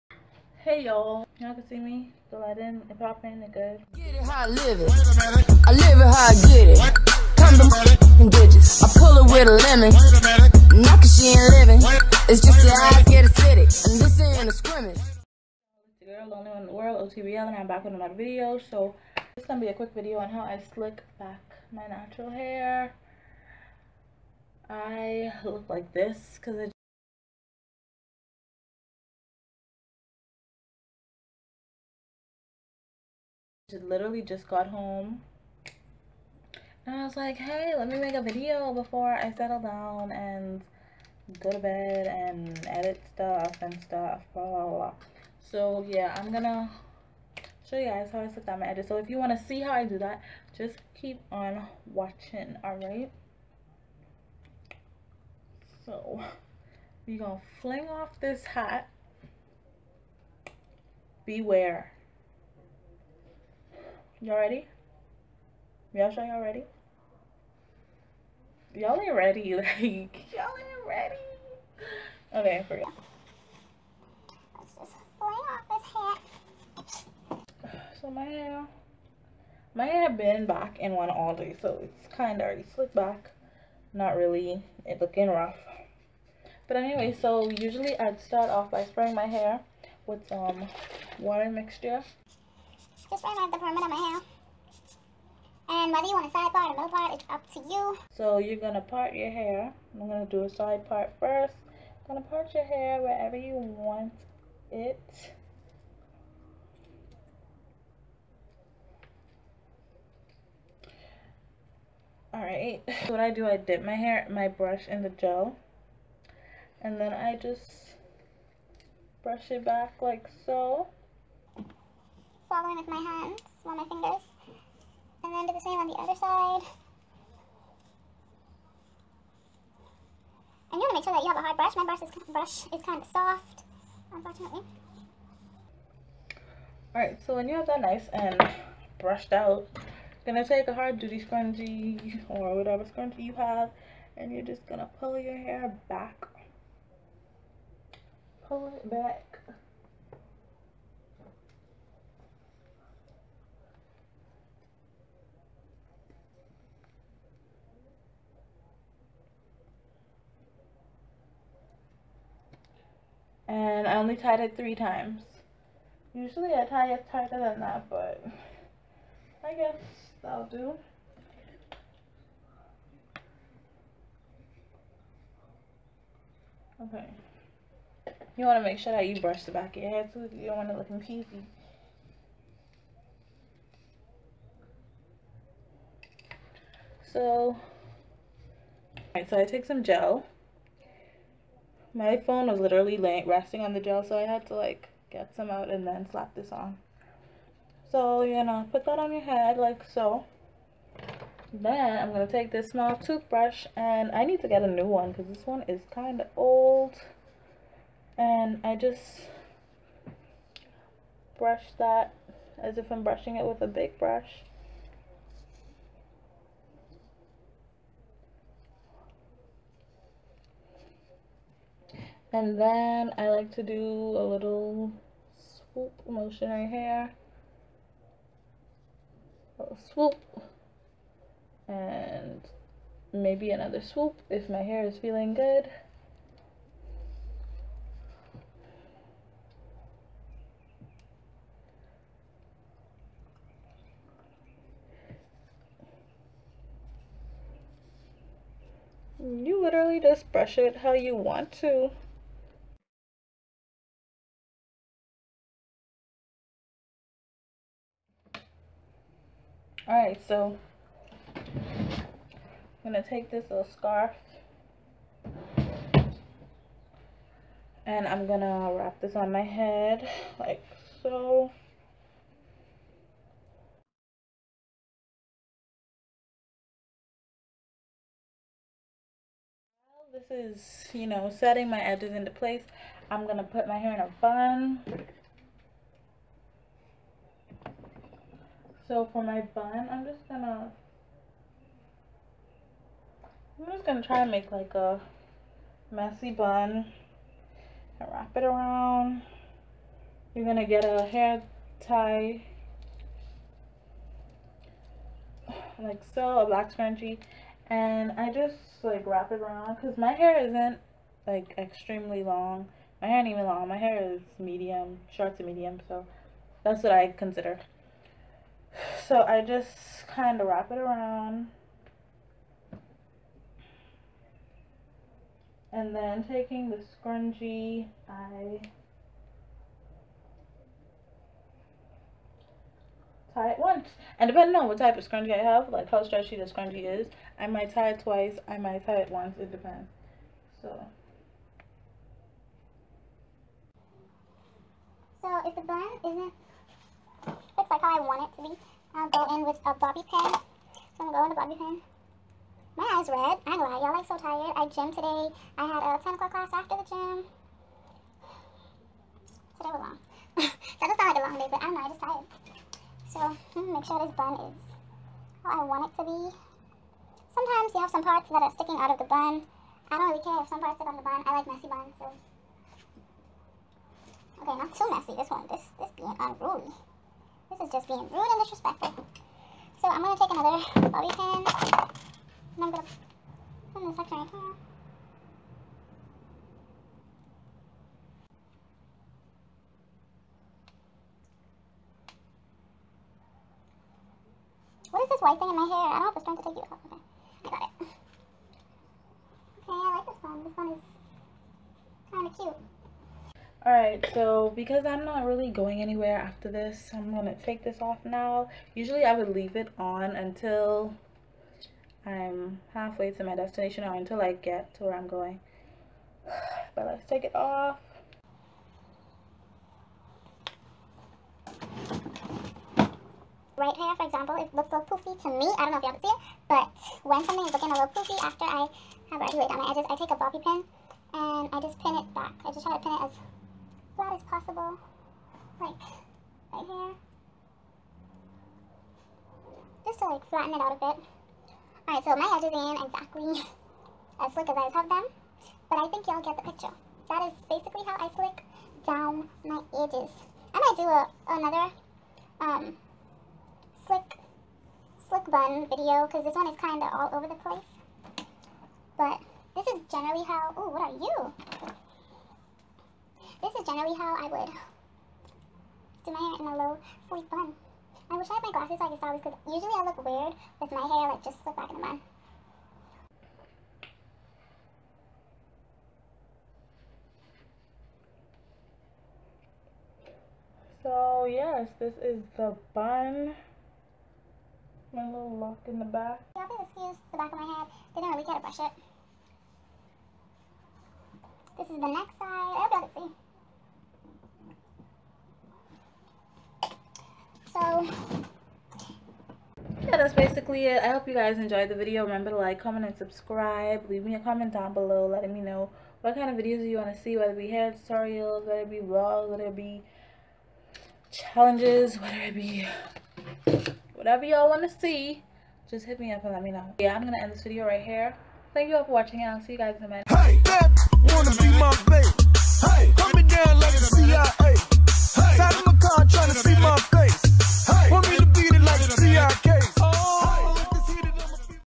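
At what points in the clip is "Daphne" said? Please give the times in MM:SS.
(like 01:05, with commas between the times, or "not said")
not said.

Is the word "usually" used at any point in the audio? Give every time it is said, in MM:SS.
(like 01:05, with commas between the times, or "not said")
01:27, 02:46, 06:48, 07:49.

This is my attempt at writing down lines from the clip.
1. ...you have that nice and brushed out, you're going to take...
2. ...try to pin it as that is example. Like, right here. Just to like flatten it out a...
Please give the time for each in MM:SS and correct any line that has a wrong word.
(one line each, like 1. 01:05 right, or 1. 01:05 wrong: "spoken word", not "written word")
1. 02:17 right
2. 07:12 wrong: "possible", not "example".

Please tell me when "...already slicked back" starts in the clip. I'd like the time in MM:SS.
01:22.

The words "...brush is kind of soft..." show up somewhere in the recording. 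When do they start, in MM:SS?
02:12.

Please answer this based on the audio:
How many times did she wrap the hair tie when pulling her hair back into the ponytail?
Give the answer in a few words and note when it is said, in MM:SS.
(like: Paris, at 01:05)
3, at 02:44.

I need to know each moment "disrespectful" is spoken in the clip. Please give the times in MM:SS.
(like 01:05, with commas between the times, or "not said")
06:18.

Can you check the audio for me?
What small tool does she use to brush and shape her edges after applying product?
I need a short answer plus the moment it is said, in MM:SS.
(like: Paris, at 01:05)
toothbrush, at 03:22.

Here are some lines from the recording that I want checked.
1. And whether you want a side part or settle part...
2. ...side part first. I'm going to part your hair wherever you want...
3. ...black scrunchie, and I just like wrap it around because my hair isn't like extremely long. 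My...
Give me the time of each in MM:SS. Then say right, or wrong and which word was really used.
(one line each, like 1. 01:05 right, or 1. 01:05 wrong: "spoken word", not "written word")
1. 01:35 wrong: "middle", not "settle"
2. 01:40 right
3. 05:06 right.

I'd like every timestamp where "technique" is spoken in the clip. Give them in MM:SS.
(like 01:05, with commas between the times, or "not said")
not said.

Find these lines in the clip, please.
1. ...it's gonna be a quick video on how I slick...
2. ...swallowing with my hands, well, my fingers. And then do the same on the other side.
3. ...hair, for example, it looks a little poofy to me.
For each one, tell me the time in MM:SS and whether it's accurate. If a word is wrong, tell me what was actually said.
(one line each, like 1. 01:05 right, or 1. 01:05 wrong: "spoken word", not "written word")
1. 00:19 right
2. 02:02 right
3. 07:03 right.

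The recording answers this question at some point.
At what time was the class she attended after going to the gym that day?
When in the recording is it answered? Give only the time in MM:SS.
05:56.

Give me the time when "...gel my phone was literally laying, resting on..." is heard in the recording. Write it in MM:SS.
03:09.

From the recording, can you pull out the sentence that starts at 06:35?
I don't have the strength to take you off.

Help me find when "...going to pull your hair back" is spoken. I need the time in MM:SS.
02:24.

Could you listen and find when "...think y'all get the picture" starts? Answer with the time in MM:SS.
07:25.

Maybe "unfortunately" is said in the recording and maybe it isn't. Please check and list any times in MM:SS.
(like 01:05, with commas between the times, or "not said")
02:14.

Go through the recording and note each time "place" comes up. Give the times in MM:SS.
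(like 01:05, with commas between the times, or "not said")
04:42, 07:37.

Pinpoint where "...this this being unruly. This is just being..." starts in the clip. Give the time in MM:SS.
06:15.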